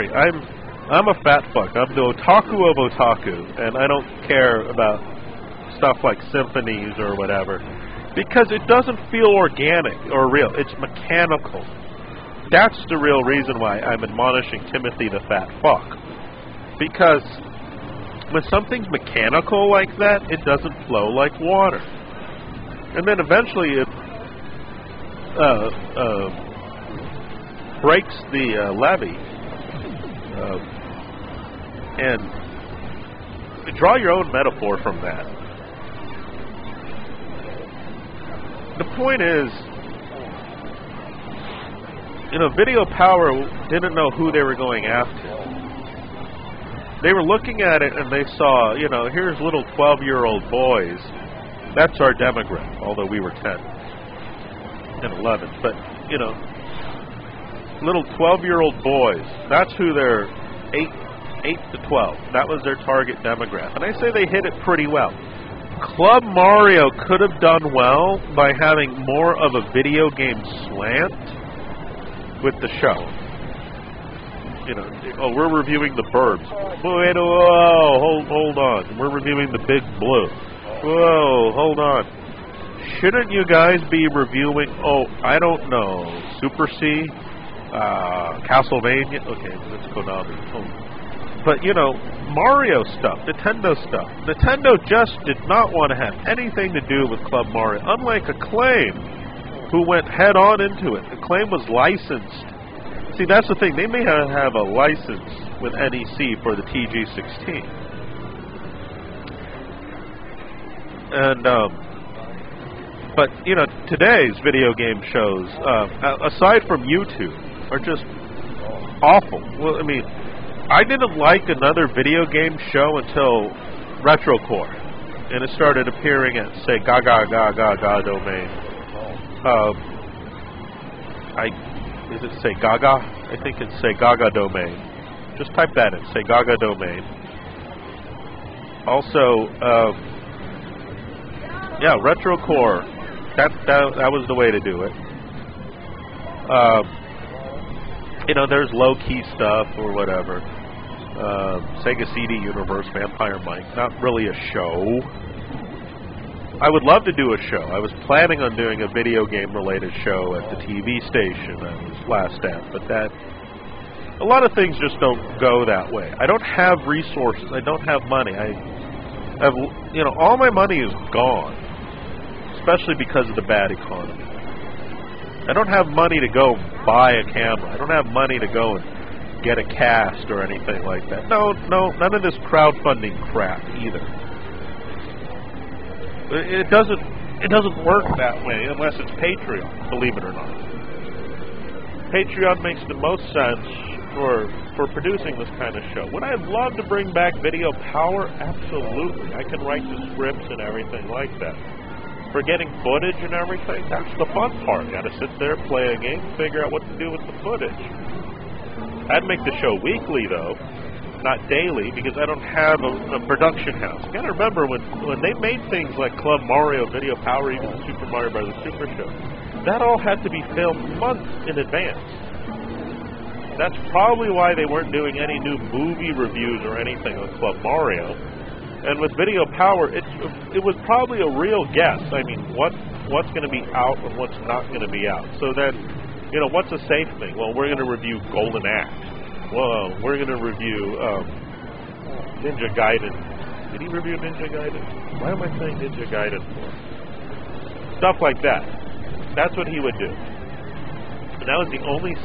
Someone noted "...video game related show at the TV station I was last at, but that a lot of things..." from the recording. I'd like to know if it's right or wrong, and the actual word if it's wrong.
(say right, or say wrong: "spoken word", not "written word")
right.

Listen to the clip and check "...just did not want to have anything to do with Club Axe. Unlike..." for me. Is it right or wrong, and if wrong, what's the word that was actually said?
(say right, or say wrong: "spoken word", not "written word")
wrong: "Mario", not "Axe".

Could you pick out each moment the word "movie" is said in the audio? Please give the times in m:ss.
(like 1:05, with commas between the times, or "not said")
3:45.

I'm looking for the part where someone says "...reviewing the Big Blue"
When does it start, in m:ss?
1:19.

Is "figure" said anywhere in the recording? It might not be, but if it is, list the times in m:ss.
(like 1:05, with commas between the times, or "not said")
3:26.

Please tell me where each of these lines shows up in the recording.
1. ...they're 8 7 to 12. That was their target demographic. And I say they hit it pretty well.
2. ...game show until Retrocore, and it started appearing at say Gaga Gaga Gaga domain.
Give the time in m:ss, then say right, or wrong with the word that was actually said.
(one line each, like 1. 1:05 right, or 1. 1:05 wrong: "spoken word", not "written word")
1. 0:59 wrong: "8", not "7"
2. 2:02 right.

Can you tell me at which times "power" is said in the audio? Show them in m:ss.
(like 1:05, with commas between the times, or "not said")
0:42, 3:17, 3:37, 3:49.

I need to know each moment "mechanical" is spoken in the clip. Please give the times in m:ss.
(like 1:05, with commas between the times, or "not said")
0:10, 0:18.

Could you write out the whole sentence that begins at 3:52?
I mean, what what's going to be out and what's not going to be out.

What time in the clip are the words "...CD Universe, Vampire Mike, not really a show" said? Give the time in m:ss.
2:32.